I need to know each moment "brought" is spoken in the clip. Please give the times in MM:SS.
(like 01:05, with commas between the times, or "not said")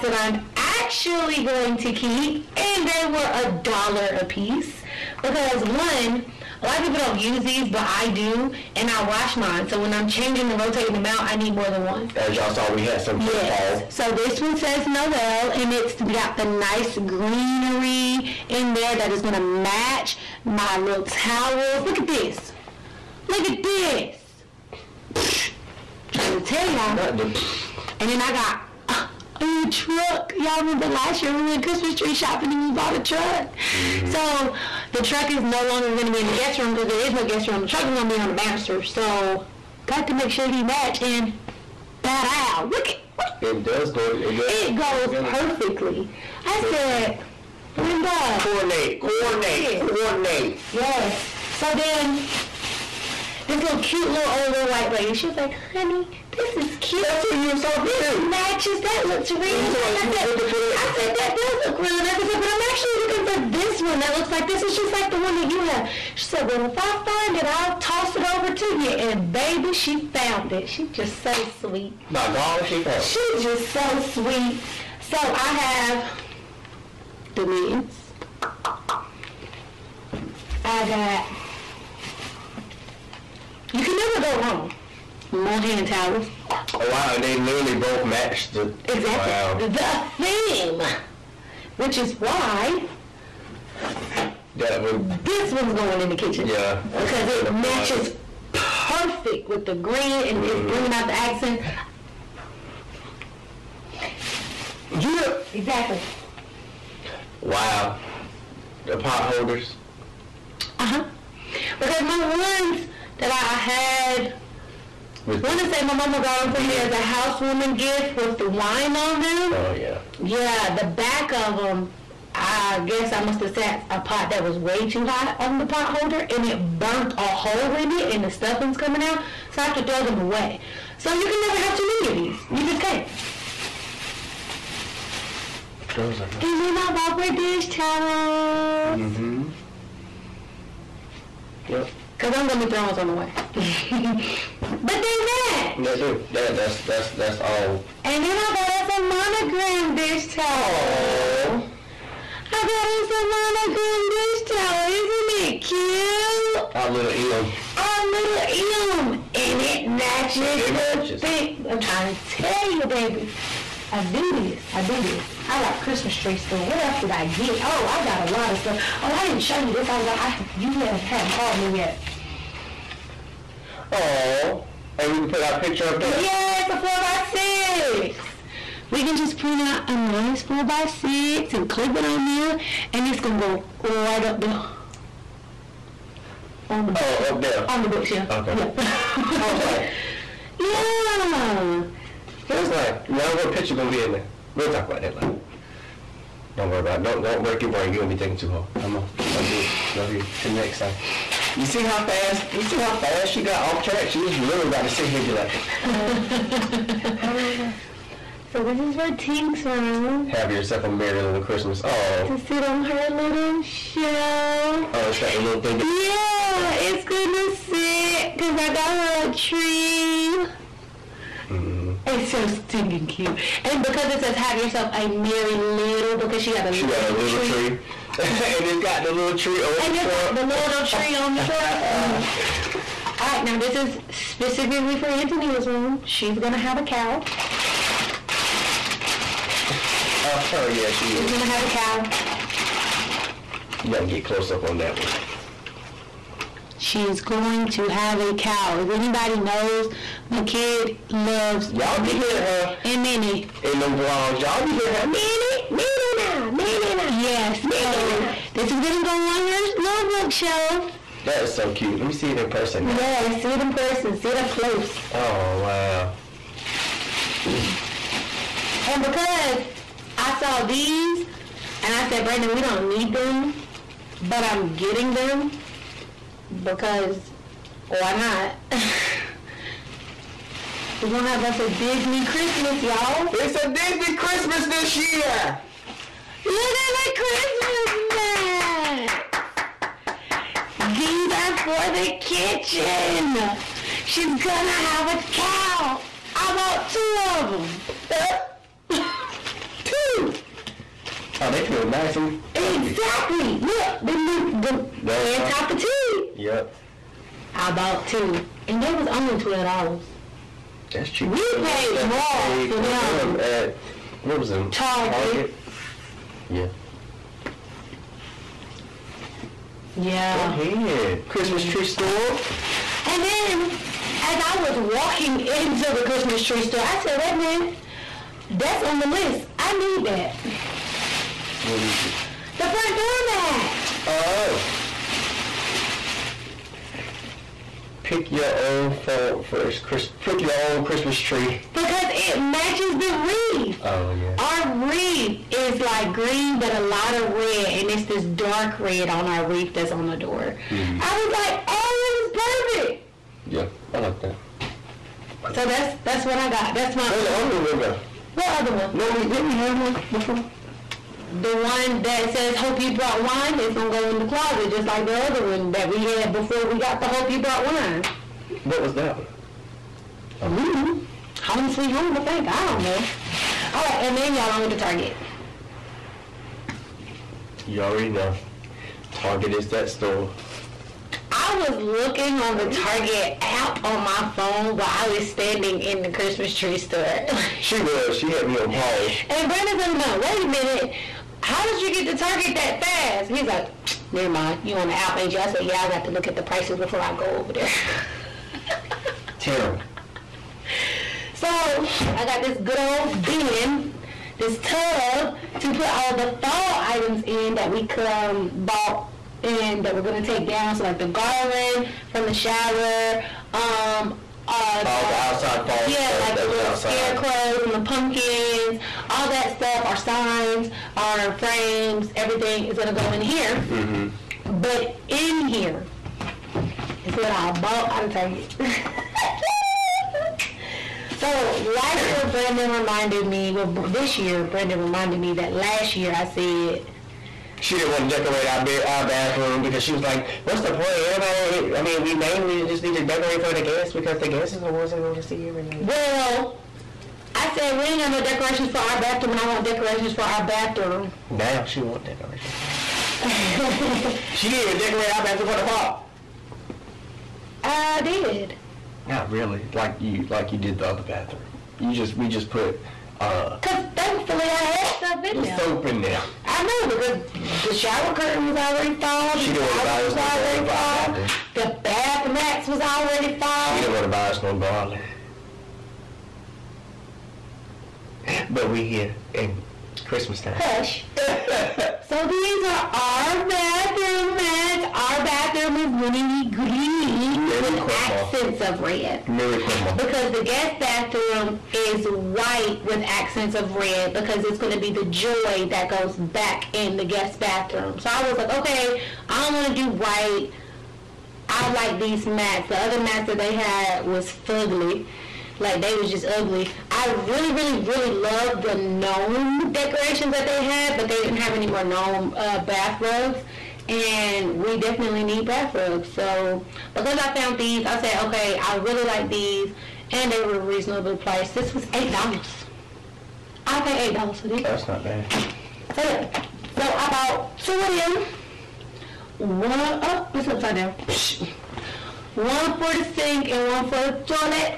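06:02, 06:07.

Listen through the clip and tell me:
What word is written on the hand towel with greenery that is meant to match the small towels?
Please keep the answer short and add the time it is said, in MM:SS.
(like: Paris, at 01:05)
Noel, at 00:14.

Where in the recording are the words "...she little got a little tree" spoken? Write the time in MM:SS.
03:46.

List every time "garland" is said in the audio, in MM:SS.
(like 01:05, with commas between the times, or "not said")
06:51, 07:50, 07:54.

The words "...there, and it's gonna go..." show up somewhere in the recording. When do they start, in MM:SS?
03:02.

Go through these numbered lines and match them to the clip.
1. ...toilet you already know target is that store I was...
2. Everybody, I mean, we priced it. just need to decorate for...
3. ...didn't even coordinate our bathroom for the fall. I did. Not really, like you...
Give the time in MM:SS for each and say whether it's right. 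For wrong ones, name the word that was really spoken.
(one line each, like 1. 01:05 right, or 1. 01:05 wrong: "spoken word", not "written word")
1. 06:14 wrong: "target", not "toilet"
2. 07:21 wrong: "named", not "priced"
3. 07:34 wrong: "decorate", not "coordinate".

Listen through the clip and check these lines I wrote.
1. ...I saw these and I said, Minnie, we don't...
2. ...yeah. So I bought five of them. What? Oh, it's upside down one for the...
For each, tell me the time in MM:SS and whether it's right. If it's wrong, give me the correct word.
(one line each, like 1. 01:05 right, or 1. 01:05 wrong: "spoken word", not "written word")
1. 04:30 wrong: "Brandon", not "Minnie"
2. 08:46 wrong: "two", not "five".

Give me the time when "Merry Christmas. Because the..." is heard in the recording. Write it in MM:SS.
08:09.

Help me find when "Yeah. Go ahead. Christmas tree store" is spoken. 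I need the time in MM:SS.
05:19.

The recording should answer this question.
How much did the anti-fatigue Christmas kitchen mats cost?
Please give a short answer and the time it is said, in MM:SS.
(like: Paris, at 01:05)
$12, at 05:09.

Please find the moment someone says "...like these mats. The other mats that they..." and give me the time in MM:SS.
08:21.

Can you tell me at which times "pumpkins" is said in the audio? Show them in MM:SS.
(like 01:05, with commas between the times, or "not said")
06:57.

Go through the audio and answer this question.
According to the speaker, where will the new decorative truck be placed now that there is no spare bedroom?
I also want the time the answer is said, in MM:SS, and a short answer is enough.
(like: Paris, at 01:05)
On the banister, at 00:38.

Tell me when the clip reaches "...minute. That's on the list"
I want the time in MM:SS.
05:27.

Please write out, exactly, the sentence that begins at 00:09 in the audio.
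So when I'm changing and rotating them out, I need more than one.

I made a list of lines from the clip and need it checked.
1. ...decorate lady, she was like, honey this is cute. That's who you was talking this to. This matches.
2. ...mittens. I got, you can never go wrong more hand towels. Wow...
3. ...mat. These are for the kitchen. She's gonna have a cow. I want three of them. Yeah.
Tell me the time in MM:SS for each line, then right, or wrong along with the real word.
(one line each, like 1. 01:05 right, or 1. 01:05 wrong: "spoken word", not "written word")
1. 00:54 wrong: "white", not "decorate"
2. 01:17 right
3. 04:50 wrong: "two", not "three".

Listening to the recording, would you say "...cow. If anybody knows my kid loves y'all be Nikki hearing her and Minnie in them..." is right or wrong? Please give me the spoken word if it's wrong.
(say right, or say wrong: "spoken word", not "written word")
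right.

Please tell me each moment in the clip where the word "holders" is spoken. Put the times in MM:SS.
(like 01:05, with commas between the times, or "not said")
01:49, 02:05.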